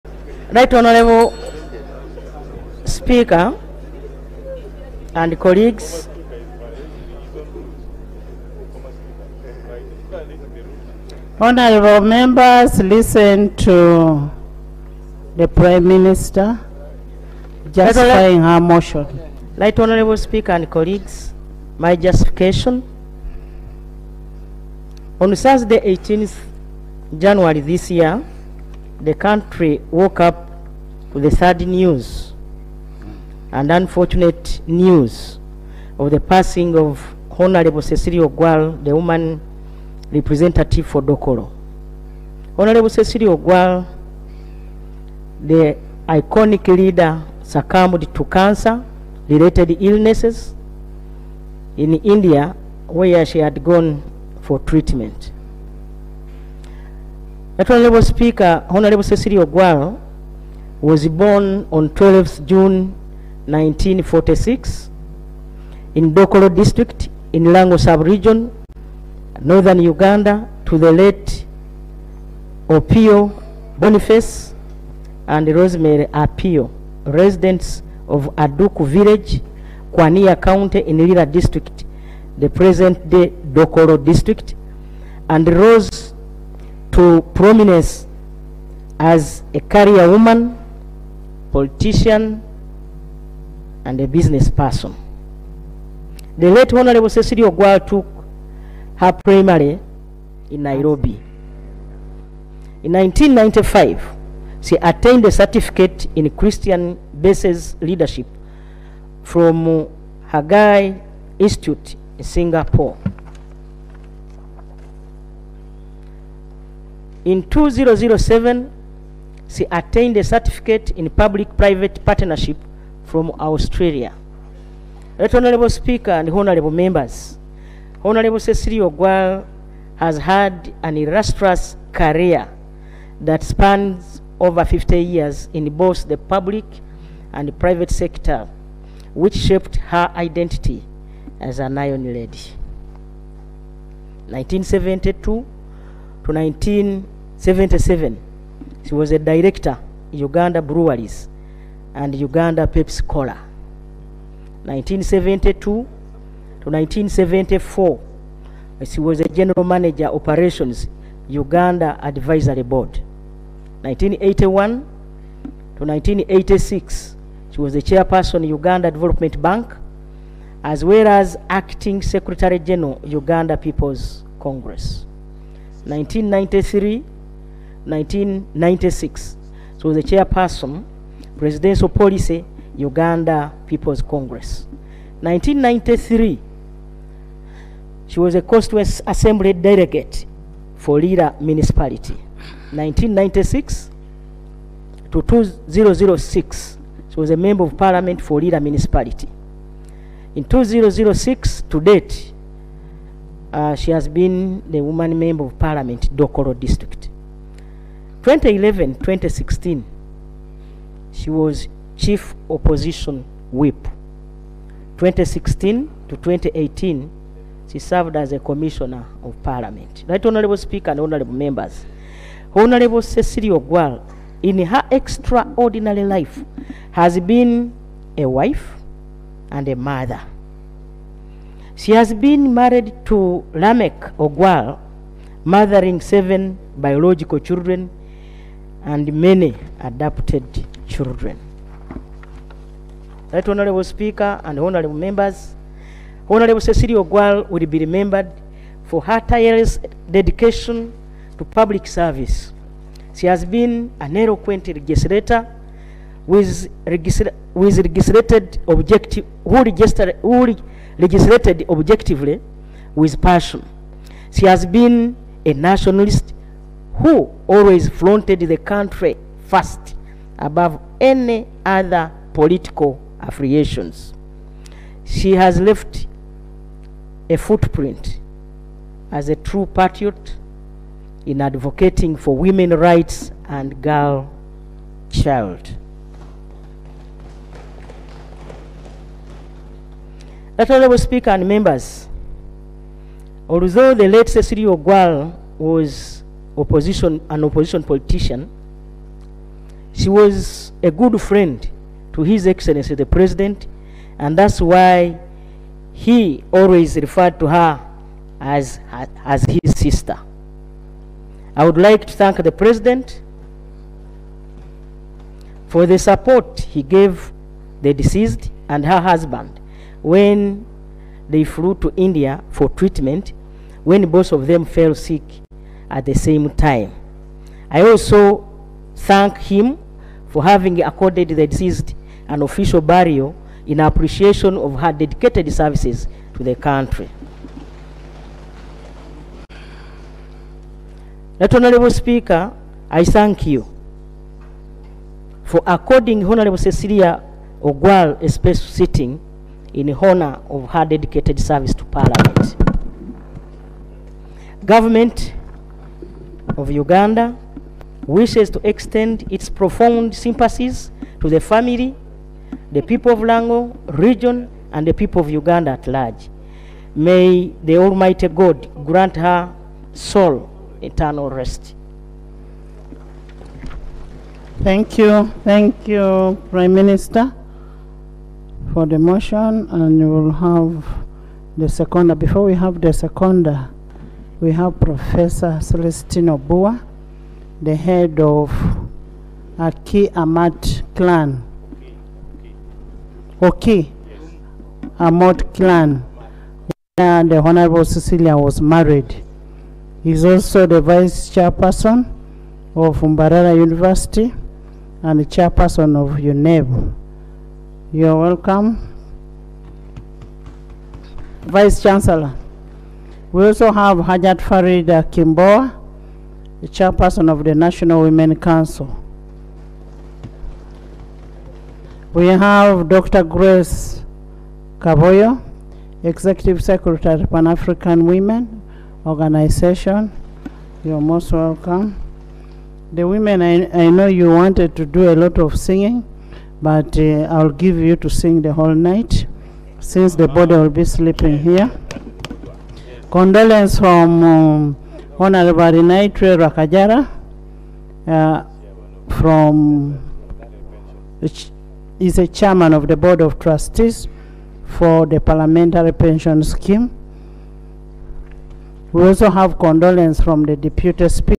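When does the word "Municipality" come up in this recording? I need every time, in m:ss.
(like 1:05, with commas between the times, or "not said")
3:11, 3:18.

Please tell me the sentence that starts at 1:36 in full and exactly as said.
The late Honorable Cecilia Ogwal took her primary in Nairobi.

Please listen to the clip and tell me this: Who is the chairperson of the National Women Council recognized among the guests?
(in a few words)
Hajat Farida Kibowa.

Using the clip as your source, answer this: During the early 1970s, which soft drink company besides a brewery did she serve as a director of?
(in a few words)
Uganda Pepsi Cola.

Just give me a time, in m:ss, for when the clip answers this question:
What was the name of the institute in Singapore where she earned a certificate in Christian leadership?
1:50.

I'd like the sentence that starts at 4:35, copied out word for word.
She has left a footprint as a true patriot in advocating for women rights and girl child.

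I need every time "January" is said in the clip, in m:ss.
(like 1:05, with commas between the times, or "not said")
0:27.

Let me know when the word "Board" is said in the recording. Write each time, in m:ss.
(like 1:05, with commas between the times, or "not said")
2:42, 7:32.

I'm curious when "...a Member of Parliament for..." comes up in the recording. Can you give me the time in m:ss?
3:17.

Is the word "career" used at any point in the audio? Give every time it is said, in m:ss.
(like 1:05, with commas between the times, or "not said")
1:29, 2:11.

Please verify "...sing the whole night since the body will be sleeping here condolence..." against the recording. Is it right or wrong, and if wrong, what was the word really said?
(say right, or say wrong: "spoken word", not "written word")
right.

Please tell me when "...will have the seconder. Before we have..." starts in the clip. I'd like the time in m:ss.
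6:20.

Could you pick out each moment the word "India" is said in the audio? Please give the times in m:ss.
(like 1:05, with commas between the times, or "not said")
0:51, 5:21.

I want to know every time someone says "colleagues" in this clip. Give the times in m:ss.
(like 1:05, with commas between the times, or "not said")
0:05, 0:20.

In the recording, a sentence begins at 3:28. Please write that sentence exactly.
2011 2016, she was chief opposition whip.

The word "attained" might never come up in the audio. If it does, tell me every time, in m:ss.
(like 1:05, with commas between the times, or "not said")
1:44, 1:59.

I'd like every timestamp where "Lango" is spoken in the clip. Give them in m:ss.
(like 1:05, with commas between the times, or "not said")
1:07, 6:03.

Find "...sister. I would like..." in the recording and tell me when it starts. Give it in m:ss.
5:09.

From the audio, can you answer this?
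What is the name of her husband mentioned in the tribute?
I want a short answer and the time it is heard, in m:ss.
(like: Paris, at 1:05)
Lamek Ogwal, at 3:53.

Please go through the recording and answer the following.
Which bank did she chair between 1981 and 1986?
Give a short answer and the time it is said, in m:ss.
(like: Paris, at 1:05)
Uganda Development Bank, at 2:48.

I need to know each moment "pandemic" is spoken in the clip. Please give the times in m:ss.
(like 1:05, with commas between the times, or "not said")
not said.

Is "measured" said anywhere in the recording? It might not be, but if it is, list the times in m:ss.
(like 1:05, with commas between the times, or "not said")
not said.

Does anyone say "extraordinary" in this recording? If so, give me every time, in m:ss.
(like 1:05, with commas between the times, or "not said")
3:44.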